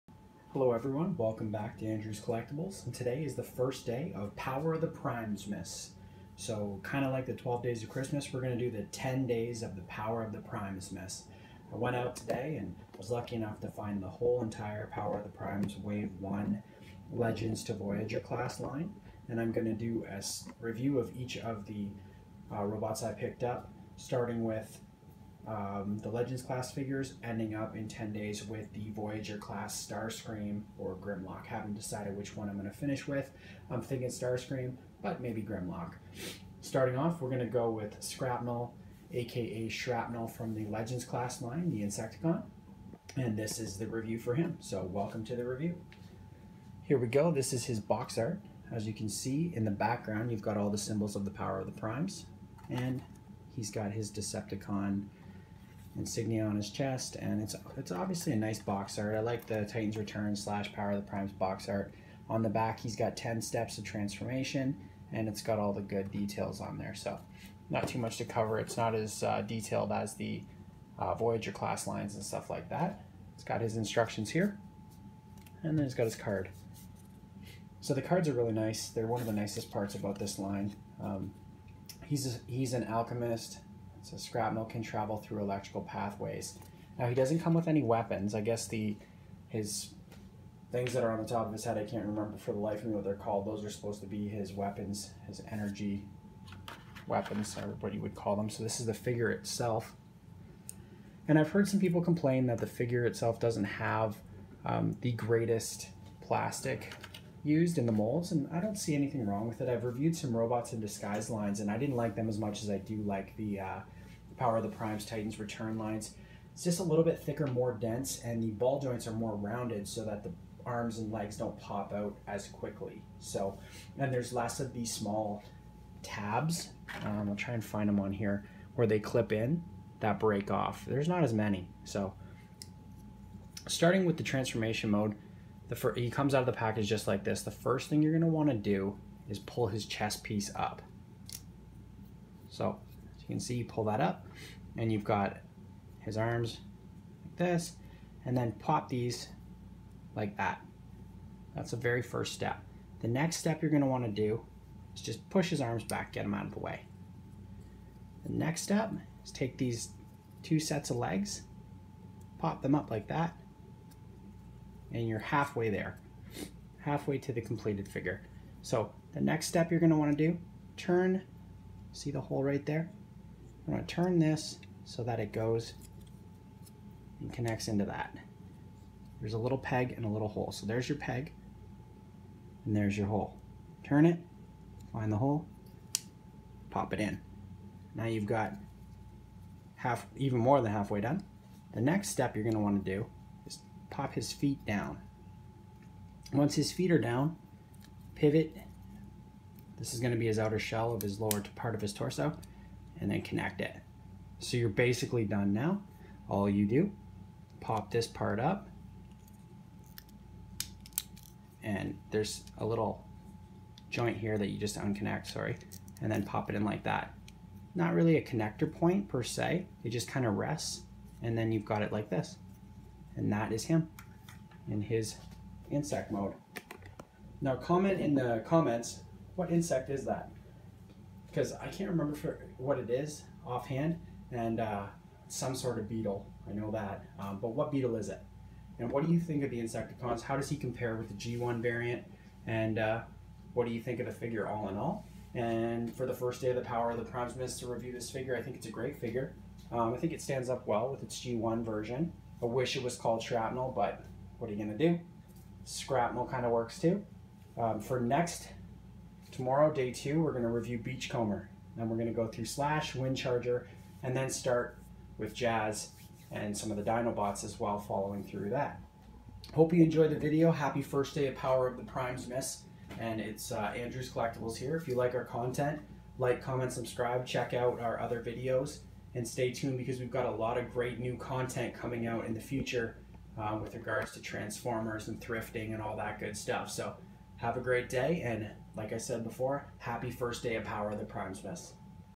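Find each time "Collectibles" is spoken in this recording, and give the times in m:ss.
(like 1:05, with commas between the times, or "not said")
0:02, 4:34.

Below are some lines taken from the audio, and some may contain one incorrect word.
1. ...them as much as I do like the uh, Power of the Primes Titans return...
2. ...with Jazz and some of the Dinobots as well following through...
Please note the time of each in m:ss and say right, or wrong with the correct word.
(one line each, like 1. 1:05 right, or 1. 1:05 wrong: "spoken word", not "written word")
1. 1:52 right
2. 4:25 right.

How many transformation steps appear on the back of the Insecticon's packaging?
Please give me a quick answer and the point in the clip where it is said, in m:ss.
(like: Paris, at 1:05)
10, at 1:03.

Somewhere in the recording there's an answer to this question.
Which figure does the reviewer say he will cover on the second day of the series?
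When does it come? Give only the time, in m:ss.
4:20.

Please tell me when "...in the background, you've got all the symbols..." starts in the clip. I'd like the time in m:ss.
0:49.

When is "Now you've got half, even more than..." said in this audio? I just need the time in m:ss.
3:07.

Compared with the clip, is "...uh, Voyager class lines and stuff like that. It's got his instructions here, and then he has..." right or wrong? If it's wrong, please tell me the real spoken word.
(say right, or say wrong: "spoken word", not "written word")
right.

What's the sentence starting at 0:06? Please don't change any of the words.
So, kind of like the 12 Days of Christmas, we're going to do the 10 Days of the Power of the Primesmas.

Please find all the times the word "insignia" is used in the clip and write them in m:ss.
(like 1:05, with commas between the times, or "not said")
0:55.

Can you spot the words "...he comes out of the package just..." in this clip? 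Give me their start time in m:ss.
2:15.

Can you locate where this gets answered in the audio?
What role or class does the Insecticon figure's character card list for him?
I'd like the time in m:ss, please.
1:22.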